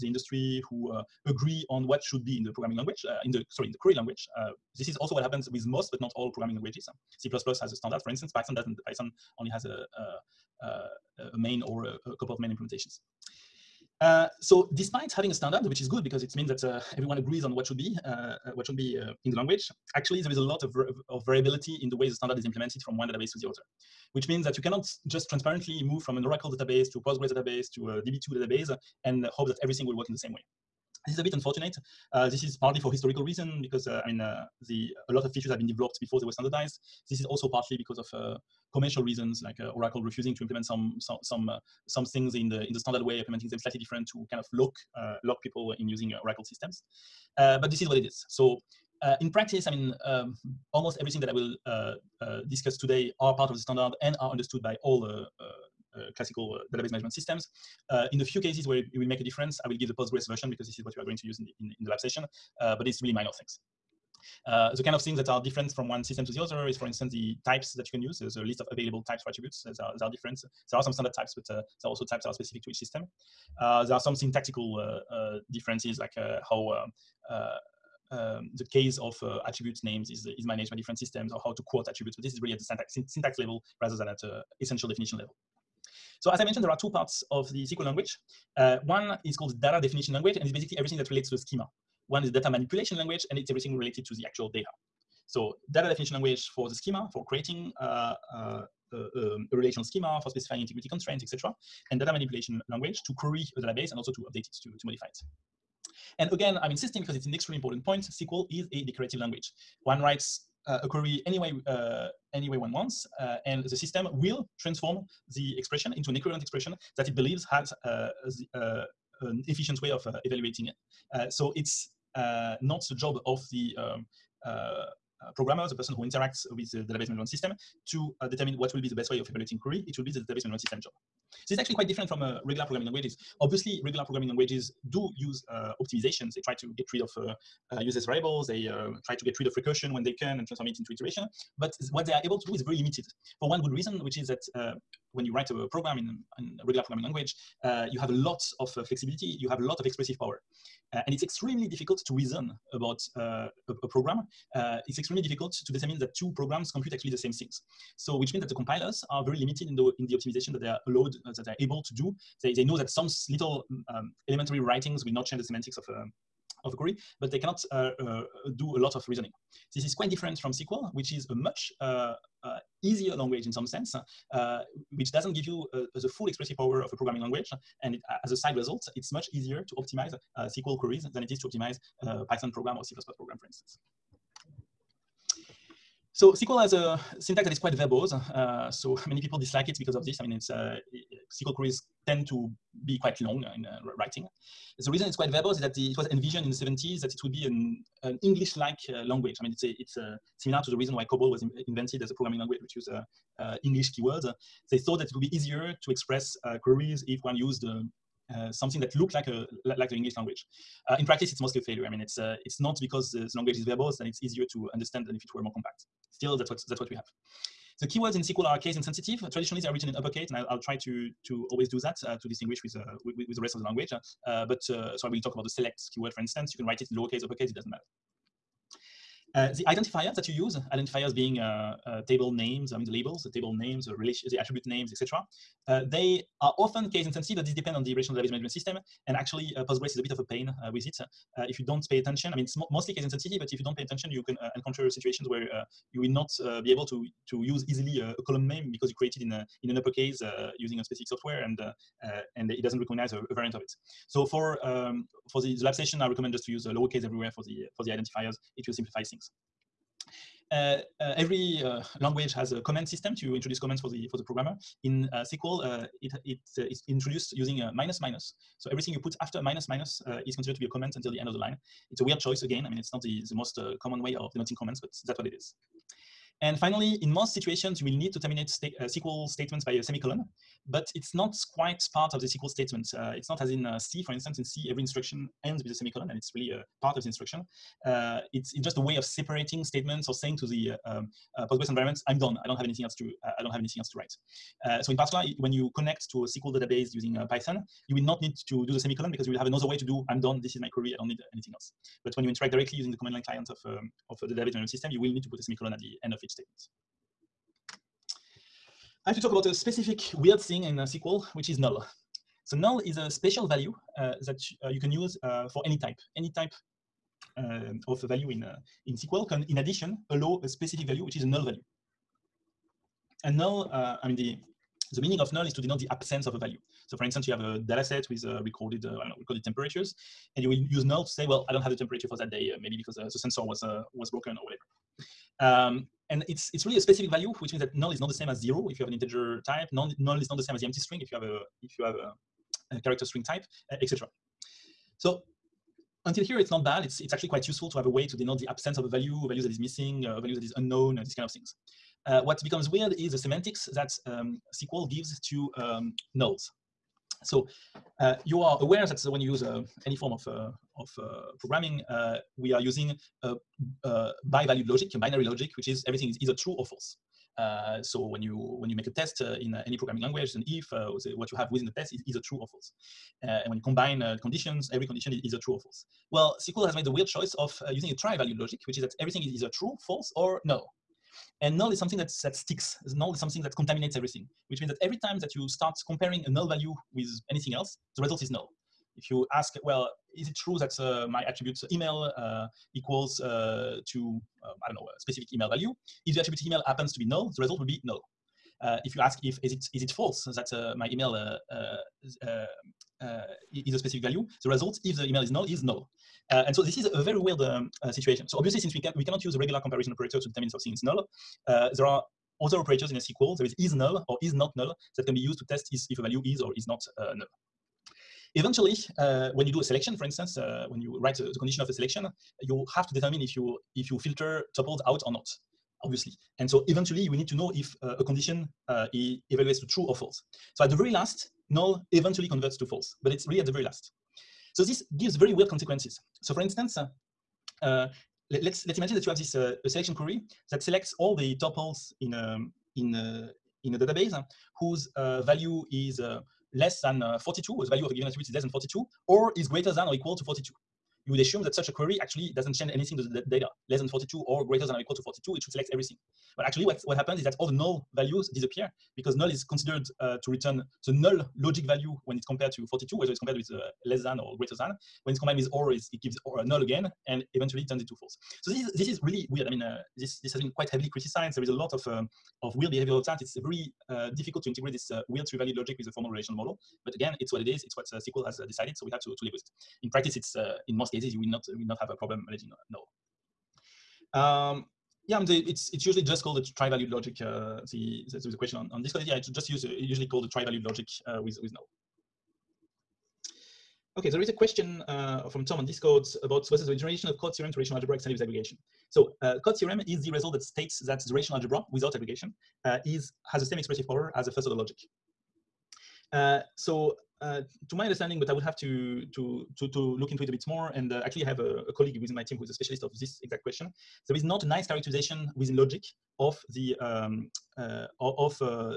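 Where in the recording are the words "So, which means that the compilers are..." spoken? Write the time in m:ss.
2:37.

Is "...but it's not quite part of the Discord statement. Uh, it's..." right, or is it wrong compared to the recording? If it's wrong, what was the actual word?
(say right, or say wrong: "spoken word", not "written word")
wrong: "SQL", not "Discord".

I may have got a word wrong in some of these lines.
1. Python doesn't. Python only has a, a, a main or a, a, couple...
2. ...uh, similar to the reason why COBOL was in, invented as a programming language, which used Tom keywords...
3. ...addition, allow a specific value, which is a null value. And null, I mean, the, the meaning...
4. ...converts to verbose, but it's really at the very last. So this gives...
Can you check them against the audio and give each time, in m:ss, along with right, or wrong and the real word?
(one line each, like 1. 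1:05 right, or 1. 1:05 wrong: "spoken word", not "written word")
1. 0:08 right
2. 3:20 wrong: "English", not "Tom"
3. 5:19 right
4. 7:12 wrong: "false", not "verbose".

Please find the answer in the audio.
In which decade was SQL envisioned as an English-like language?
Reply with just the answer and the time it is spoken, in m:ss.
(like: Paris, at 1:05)
the 70s, at 3:16.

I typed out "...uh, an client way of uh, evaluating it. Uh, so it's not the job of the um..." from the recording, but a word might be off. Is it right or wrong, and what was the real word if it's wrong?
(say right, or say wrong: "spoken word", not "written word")
wrong: "efficient", not "client".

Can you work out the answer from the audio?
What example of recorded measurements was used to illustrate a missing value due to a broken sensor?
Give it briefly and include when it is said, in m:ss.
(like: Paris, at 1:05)
temperatures, at 5:29.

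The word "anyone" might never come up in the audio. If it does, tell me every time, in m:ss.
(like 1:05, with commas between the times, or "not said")
not said.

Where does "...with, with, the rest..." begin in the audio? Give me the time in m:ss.
3:43.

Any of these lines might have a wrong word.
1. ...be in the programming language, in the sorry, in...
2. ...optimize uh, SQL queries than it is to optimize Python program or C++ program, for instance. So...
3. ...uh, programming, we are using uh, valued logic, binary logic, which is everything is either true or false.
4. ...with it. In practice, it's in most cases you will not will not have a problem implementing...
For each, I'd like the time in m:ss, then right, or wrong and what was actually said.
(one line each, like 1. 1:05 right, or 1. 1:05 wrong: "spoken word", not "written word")
1. 0:02 right
2. 2:59 right
3. 6:00 right
4. 7:59 wrong: "managing", not "implementing".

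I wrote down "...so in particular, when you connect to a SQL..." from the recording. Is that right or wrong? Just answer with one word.
right.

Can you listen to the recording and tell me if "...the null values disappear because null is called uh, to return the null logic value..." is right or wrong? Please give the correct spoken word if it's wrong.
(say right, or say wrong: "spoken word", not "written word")
wrong: "considered", not "called".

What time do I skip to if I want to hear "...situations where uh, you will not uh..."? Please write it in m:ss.
4:04.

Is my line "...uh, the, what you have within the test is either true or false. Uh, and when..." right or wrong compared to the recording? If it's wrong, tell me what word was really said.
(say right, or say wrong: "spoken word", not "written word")
right.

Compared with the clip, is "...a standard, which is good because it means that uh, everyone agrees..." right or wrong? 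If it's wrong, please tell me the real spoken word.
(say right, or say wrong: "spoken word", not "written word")
right.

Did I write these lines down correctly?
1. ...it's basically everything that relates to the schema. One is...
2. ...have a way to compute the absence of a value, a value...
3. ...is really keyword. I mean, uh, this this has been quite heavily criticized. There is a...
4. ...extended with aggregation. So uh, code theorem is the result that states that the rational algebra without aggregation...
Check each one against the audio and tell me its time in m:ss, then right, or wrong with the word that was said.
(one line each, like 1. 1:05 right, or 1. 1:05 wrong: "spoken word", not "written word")
1. 1:30 right
2. 5:47 wrong: "denote", not "compute"
3. 7:48 wrong: "weird", not "keyword"
4. 8:17 right.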